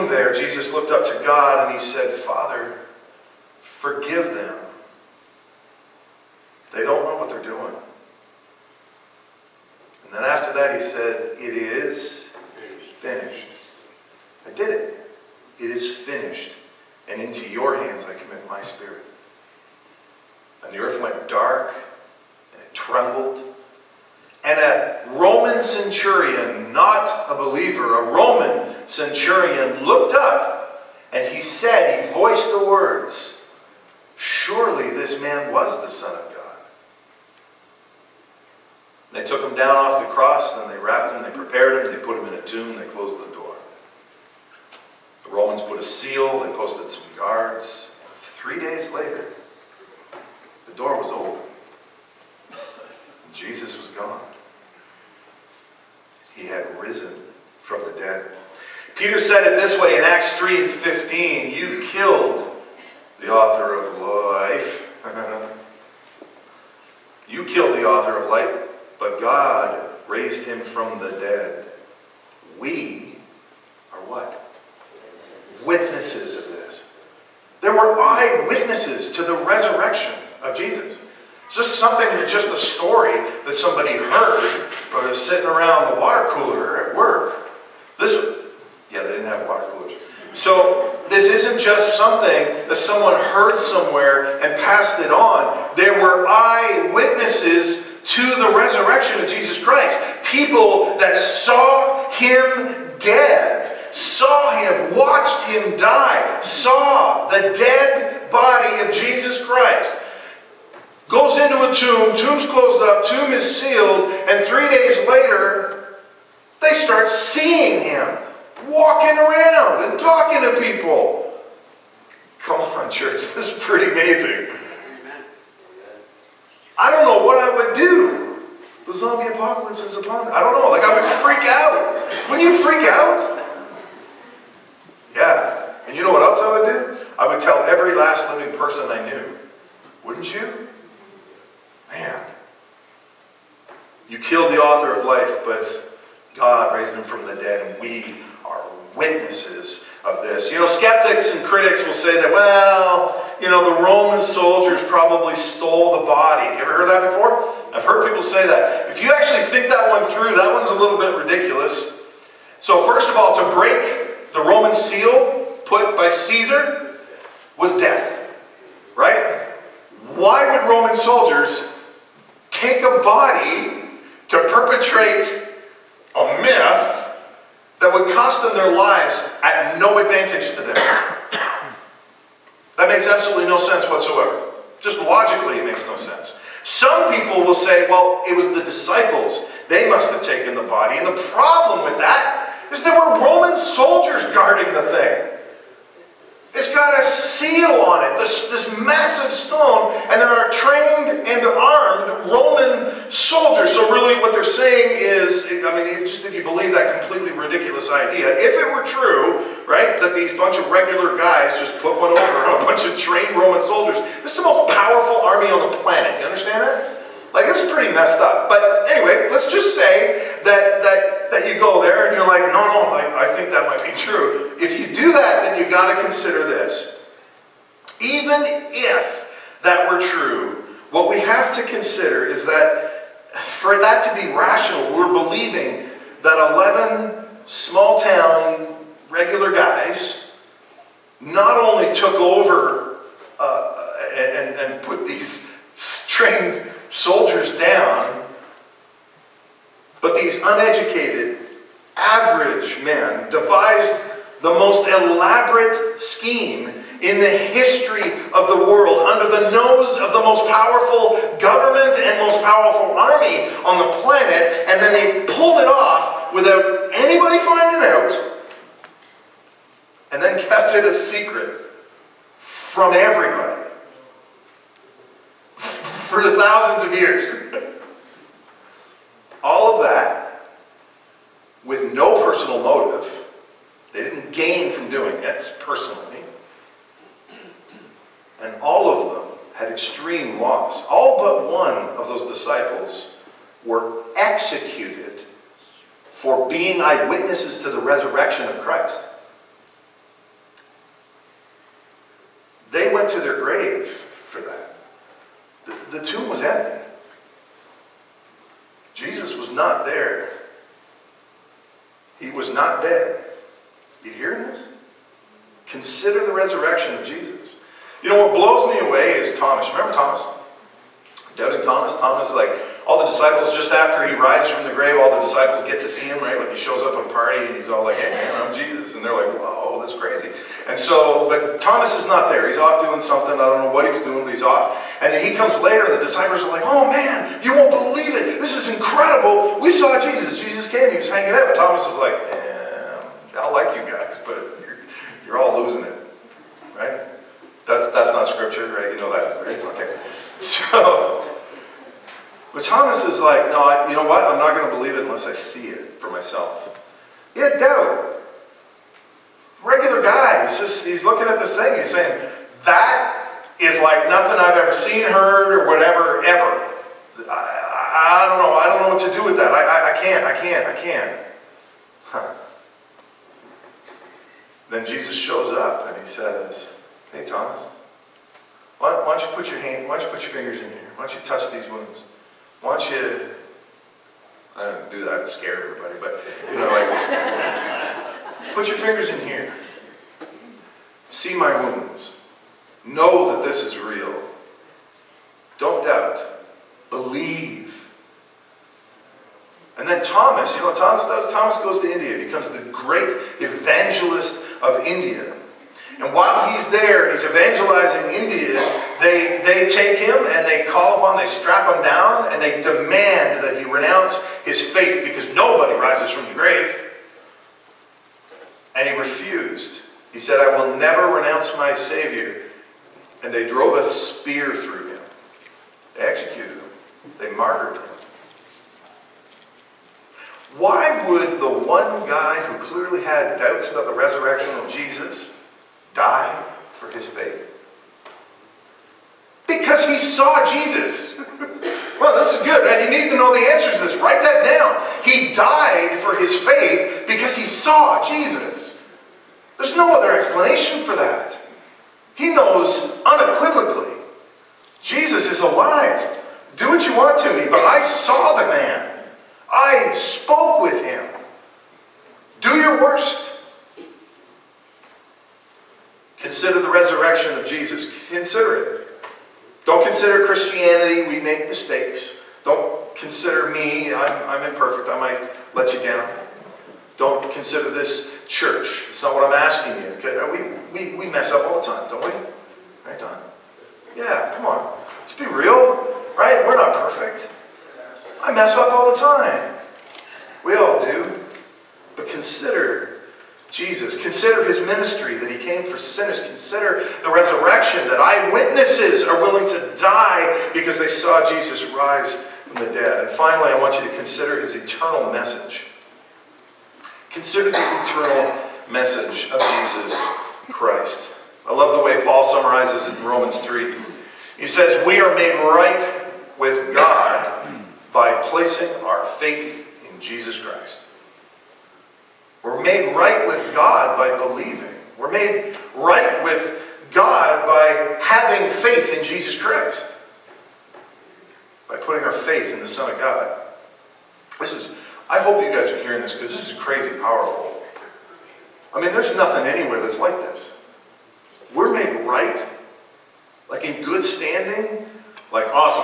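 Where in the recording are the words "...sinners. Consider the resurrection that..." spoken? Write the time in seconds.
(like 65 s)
495 s.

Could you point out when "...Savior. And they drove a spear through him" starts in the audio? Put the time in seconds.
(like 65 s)
421 s.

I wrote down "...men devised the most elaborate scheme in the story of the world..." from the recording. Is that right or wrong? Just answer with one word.
wrong.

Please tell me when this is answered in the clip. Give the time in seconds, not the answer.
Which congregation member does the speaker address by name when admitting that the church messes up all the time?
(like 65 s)
482 s.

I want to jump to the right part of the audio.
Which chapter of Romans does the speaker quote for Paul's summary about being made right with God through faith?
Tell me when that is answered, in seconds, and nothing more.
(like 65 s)
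513 s.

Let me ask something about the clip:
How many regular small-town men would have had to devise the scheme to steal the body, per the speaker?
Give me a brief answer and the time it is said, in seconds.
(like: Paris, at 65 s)
11, at 237 s.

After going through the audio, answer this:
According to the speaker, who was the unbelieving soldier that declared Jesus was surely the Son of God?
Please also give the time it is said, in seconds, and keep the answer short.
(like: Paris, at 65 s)
A Roman centurion, at 28 s.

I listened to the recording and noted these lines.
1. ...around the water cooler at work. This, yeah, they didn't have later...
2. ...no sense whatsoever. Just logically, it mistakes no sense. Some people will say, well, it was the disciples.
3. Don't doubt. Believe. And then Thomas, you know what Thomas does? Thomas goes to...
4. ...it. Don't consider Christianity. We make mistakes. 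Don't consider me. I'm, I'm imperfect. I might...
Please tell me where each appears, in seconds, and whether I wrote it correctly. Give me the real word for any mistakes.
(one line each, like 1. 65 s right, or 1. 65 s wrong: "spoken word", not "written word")
1. 85 s wrong: "water", not "later"
2. 183 s wrong: "makes", not "mistakes"
3. 395 s right
4. 468 s right.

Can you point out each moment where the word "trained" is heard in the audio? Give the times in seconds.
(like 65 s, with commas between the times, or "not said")
200 s, 213 s, 246 s.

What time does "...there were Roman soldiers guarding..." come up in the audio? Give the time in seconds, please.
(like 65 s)
192 s.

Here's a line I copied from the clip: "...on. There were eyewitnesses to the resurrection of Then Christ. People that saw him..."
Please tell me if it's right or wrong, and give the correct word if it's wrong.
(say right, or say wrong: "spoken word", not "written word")
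wrong: "Jesus", not "Then".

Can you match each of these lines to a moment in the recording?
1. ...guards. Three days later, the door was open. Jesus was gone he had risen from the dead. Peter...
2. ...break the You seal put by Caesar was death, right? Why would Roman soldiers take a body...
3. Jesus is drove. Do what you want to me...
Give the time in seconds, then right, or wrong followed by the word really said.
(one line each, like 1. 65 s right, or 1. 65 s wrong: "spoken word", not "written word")
1. 47 s right
2. 163 s wrong: "Roman", not "You"
3. 454 s wrong: "alive", not "drove".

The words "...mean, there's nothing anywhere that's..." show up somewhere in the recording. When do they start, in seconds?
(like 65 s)
538 s.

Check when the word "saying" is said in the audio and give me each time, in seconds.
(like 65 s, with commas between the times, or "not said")
204 s, 361 s.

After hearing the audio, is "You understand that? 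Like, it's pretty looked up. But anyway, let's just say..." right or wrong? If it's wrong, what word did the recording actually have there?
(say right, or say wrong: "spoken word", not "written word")
wrong: "messed", not "looked".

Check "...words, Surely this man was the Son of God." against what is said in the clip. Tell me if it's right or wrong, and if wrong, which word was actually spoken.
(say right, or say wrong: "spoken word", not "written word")
right.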